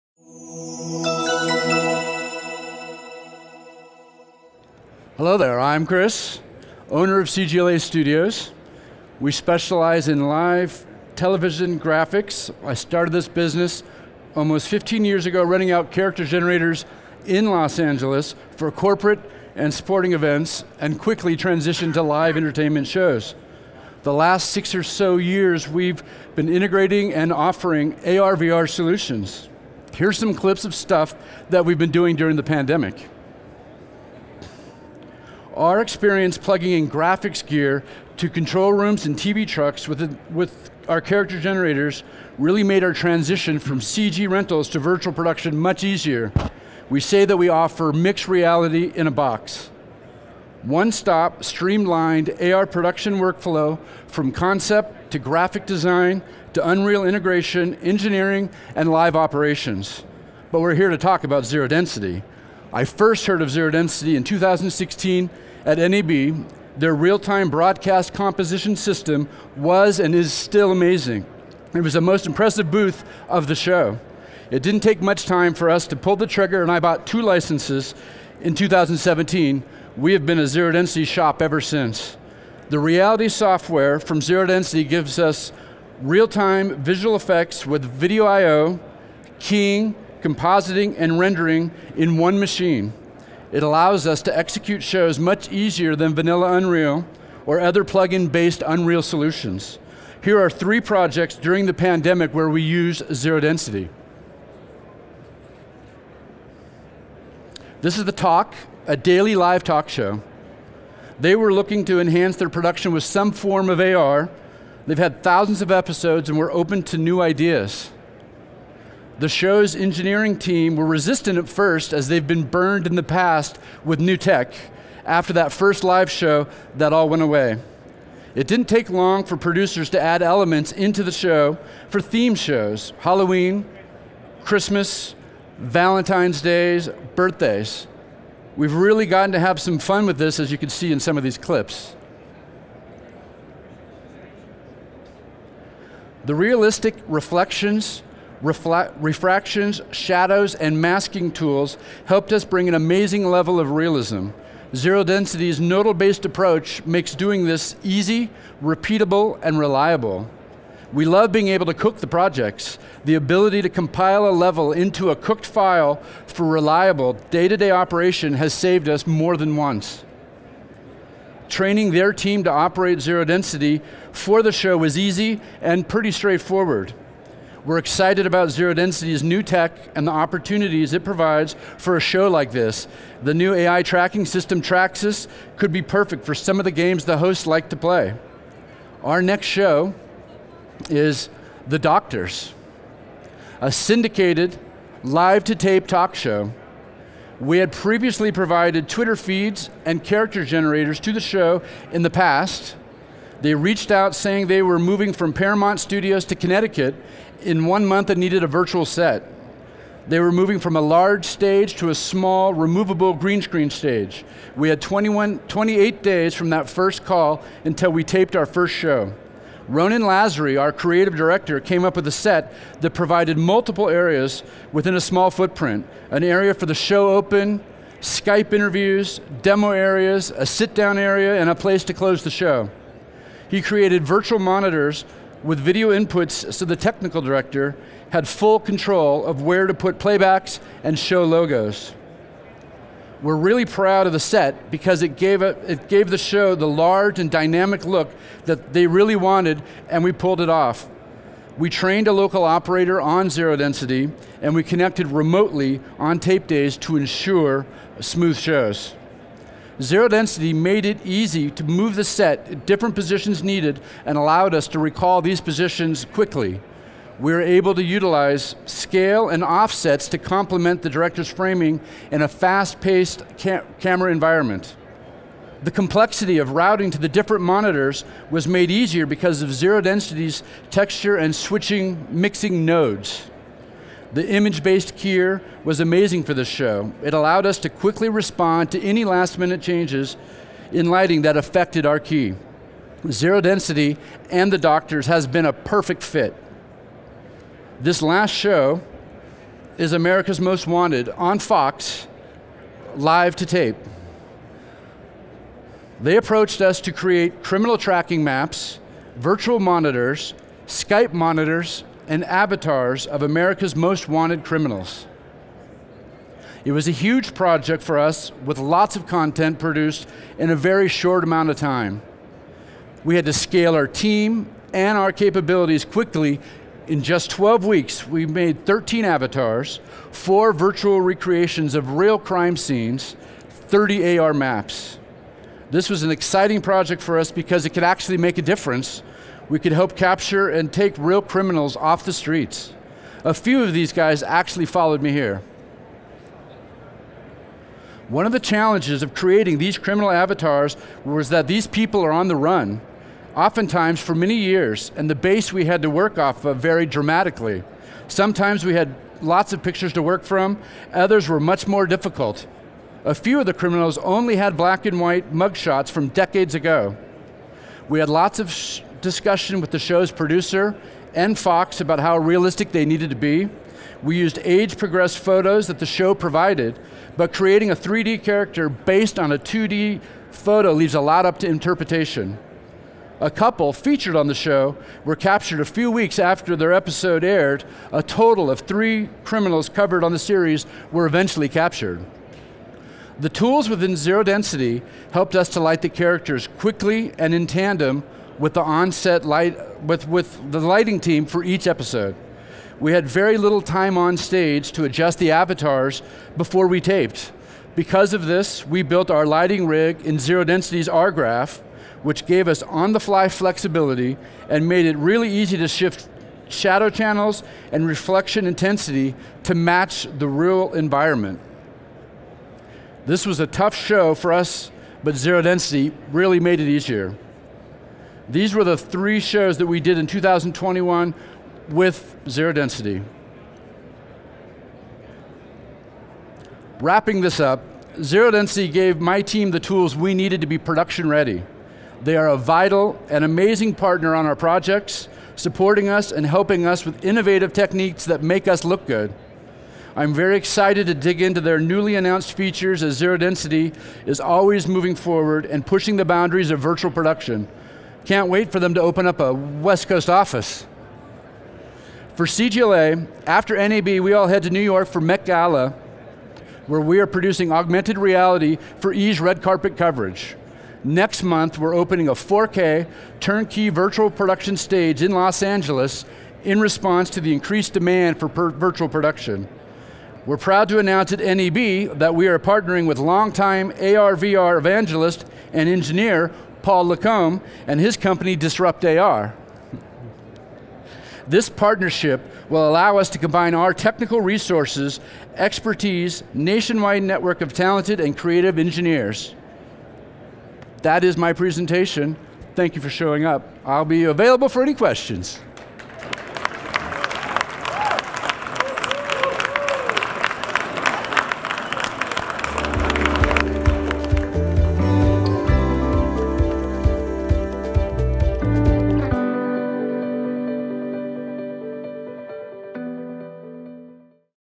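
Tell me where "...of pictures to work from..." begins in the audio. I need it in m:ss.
5:59.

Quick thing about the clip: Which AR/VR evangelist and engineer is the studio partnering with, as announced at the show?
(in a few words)
Paul Lacombe.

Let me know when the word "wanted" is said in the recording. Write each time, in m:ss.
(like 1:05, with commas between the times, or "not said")
4:09, 5:00, 5:14.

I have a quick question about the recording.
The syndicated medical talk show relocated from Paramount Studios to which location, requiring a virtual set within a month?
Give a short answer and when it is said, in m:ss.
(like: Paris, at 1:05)
Connecticut, at 3:26.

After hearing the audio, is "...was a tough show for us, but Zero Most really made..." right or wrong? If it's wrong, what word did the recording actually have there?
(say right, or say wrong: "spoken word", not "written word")
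wrong: "Density", not "Most".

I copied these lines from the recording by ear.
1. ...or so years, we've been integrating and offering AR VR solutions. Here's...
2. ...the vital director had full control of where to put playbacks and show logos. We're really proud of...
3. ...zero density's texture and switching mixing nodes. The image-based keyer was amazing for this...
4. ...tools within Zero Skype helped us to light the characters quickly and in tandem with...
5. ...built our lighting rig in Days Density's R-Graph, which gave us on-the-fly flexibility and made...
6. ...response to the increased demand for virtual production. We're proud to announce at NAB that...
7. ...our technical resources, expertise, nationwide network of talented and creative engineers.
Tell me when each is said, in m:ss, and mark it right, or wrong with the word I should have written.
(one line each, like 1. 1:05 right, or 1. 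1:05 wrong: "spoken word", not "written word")
1. 0:24 right
2. 3:56 wrong: "technical", not "vital"
3. 4:39 right
4. 6:33 wrong: "Density", not "Skype"
5. 6:48 wrong: "Zero", not "Days"
6. 7:56 right
7. 8:13 right.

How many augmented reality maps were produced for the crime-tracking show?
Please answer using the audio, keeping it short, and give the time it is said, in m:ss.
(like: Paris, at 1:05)
30, at 5:33.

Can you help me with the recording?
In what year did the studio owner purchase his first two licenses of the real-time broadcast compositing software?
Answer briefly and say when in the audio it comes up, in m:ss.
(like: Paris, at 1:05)
2017, at 1:18.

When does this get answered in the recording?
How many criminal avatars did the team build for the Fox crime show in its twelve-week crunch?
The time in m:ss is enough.
5:28.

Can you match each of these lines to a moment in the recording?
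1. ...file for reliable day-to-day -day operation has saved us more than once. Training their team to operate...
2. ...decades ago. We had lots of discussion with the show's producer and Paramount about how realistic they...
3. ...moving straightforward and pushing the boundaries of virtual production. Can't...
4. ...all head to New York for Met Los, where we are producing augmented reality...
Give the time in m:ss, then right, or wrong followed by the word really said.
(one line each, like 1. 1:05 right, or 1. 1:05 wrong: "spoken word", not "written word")
1. 2:45 right
2. 6:06 wrong: "Fox", not "Paramount"
3. 7:34 wrong: "forward", not "straightforward"
4. 7:44 wrong: "Gala", not "Los".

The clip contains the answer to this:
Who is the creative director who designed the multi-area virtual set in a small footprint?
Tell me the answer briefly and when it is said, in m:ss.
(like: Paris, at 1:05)
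Ronan Lazary, at 3:39.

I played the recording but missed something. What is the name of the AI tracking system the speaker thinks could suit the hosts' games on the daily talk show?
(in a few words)
Traxis.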